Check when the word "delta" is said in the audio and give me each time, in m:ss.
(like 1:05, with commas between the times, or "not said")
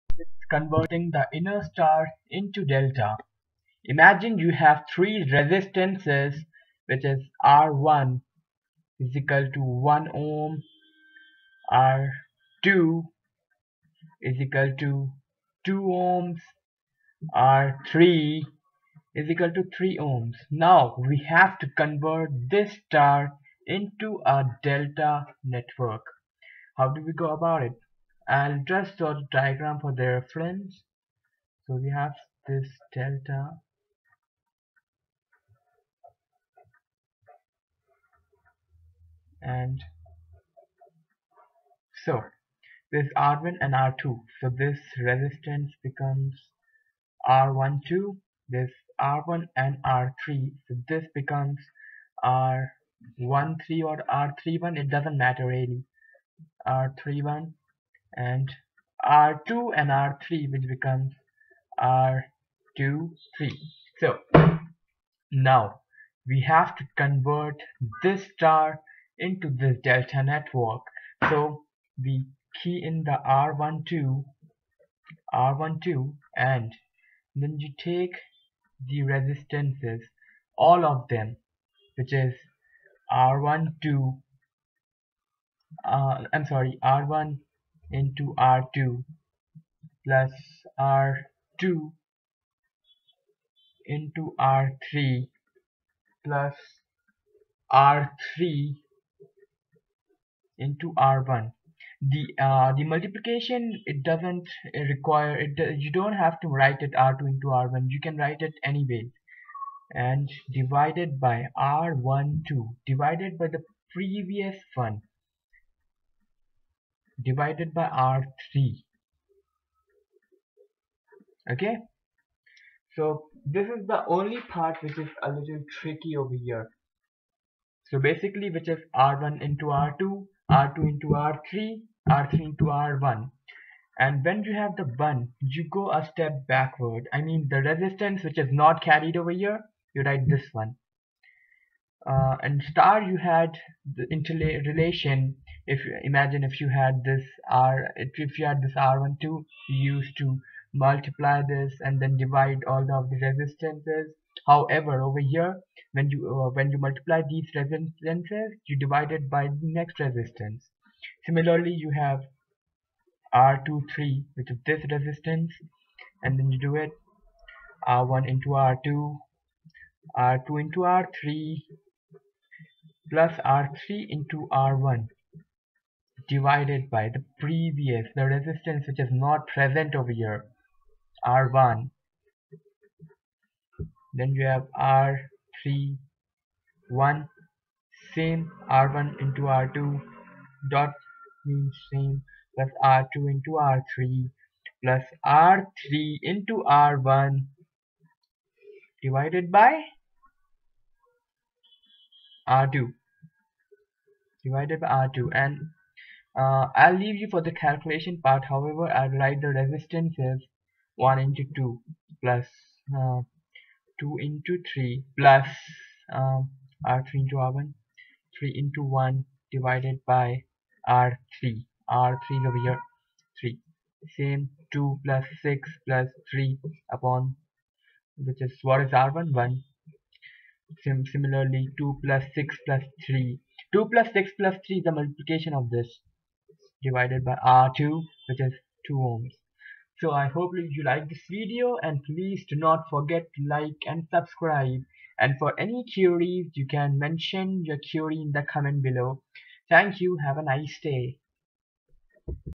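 0:02, 0:24, 0:32, 1:09.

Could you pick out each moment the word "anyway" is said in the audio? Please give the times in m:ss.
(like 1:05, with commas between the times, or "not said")
1:48.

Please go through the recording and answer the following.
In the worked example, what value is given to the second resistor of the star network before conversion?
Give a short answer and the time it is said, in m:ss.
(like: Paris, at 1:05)
2 ohms, at 0:11.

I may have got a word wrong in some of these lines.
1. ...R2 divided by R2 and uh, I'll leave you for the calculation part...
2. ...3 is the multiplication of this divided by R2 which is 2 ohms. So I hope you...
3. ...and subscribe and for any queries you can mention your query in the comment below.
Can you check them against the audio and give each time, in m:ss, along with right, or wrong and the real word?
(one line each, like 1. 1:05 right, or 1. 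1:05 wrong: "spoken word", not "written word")
1. 3:22 right
2. 3:54 right
3. 4:03 right.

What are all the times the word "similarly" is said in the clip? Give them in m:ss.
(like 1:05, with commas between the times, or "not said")
2:41, 3:51.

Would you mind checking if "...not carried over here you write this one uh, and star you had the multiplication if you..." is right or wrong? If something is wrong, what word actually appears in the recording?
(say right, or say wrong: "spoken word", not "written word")
wrong: "interrelation", not "multiplication".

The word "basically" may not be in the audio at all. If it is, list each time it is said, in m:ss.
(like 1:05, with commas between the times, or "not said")
2:07.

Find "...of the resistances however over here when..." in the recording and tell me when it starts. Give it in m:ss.
2:32.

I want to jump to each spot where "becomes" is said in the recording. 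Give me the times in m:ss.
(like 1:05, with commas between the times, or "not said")
0:45, 0:51, 1:00.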